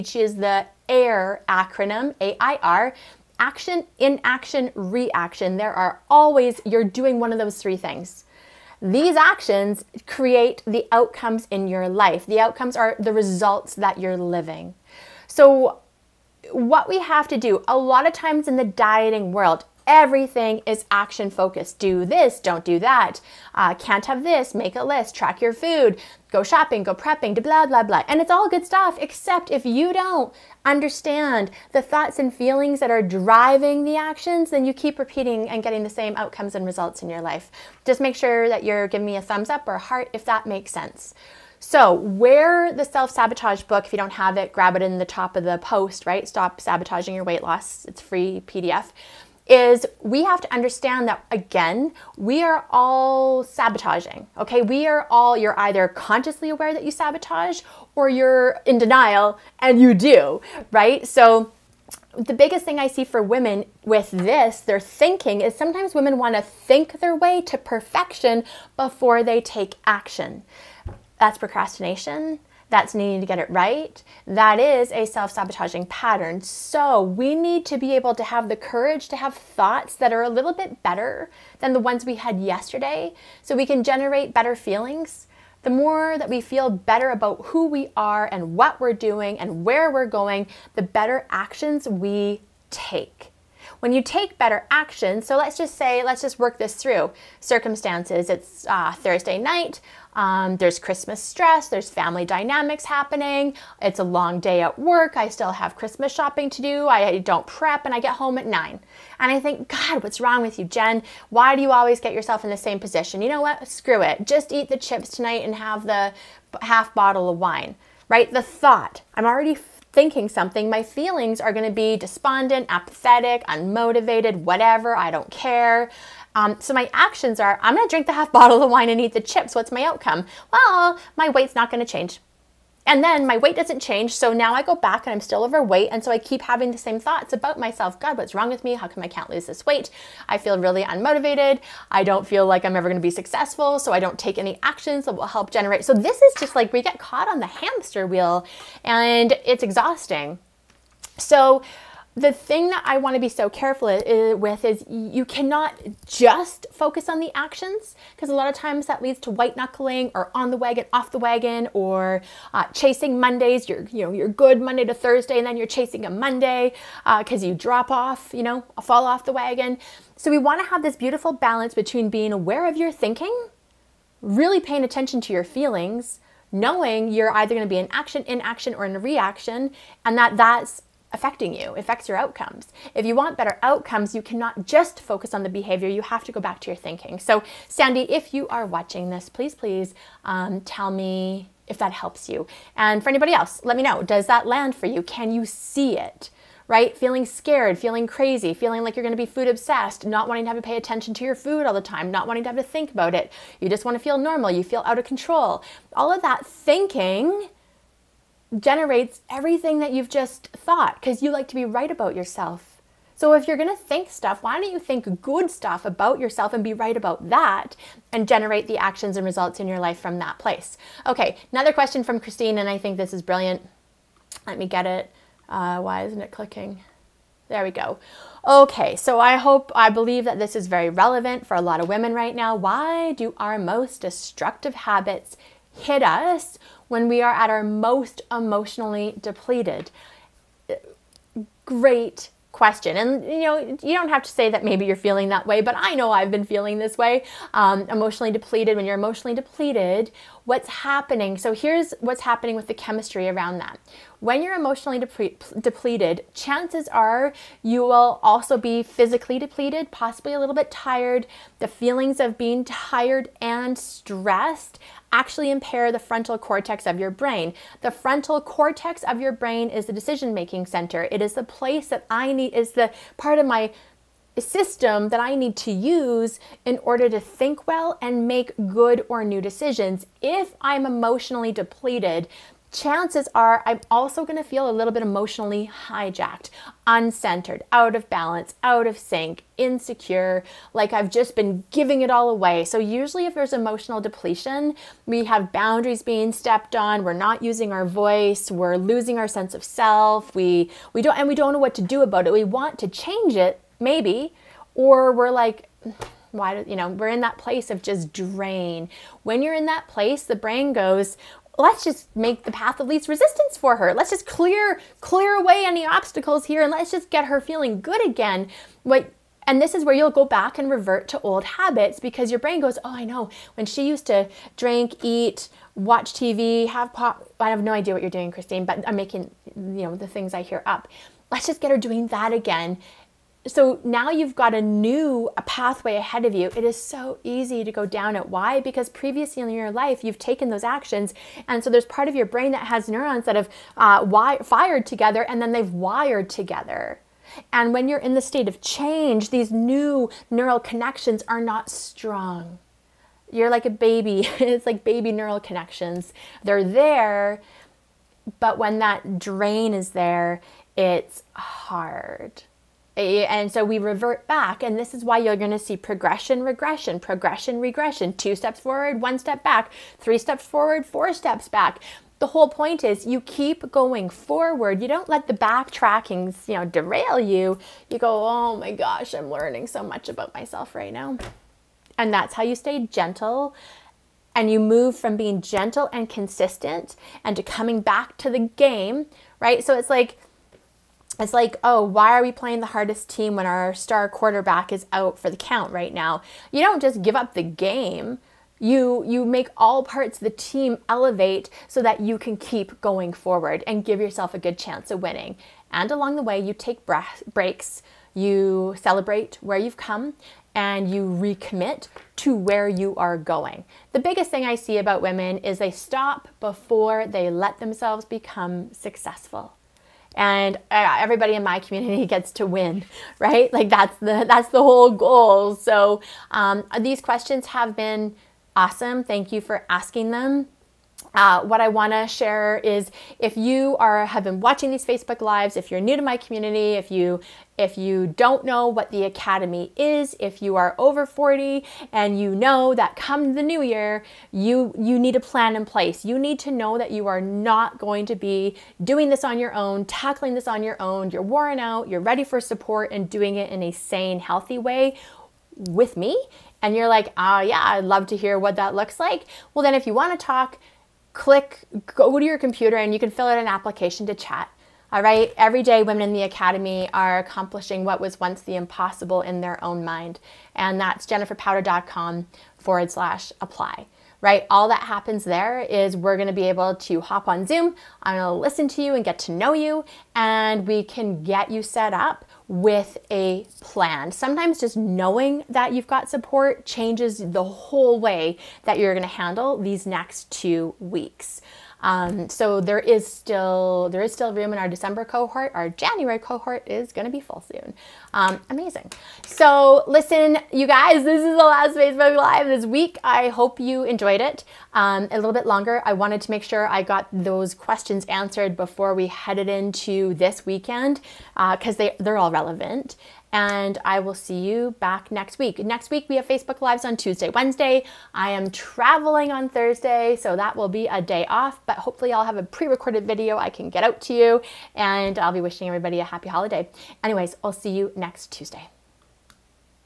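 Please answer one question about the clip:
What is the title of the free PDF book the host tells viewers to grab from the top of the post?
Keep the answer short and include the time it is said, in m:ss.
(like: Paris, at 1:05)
Stop Sabotaging Your Weight Loss, at 0:46.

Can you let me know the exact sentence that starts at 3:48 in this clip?
Okay, so I hope, I believe that this is very relevant for a lot of women right now.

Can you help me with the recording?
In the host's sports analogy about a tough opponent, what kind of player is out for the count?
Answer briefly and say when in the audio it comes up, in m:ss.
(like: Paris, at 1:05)
star quarterback, at 6:33.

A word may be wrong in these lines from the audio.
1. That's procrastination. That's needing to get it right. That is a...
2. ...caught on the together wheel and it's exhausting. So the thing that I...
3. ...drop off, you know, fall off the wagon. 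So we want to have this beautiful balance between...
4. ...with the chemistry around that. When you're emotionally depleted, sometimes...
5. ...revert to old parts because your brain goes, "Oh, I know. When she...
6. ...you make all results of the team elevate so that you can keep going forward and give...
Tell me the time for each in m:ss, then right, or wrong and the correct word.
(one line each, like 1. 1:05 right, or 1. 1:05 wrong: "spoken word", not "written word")
1. 1:11 right
2. 2:26 wrong: "hamster", not "together"
3. 2:47 right
4. 4:12 wrong: "chances", not "sometimes"
5. 5:20 wrong: "habits", not "parts"
6. 6:39 wrong: "parts", not "results".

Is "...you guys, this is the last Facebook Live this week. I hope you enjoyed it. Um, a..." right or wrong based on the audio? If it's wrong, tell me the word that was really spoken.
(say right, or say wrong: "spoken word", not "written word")
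right.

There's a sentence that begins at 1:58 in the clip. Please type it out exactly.
The thought, I'm already thinking something, my feelings are going to be despondent, apathetic, unmotivated, whatever, I don't care.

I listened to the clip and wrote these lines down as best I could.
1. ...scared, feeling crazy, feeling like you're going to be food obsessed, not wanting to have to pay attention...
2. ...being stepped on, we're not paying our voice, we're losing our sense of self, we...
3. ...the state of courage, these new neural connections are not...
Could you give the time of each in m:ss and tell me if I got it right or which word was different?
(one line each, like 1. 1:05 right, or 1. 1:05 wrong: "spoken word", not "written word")
1. 3:17 right
2. 4:56 wrong: "using", not "paying"
3. 5:48 wrong: "change", not "courage".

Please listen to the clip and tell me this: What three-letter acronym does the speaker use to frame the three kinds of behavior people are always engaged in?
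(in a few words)
AIR.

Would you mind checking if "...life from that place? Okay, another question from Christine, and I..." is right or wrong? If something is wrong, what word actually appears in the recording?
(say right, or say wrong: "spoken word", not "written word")
right.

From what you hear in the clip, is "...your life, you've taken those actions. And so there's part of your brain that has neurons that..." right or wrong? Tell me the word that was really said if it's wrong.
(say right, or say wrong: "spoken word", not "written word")
right.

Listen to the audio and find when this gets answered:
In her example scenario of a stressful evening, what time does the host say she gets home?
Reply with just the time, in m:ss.
1:48.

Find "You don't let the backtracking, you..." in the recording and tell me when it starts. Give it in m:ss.
6:14.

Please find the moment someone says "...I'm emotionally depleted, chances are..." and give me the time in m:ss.
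4:40.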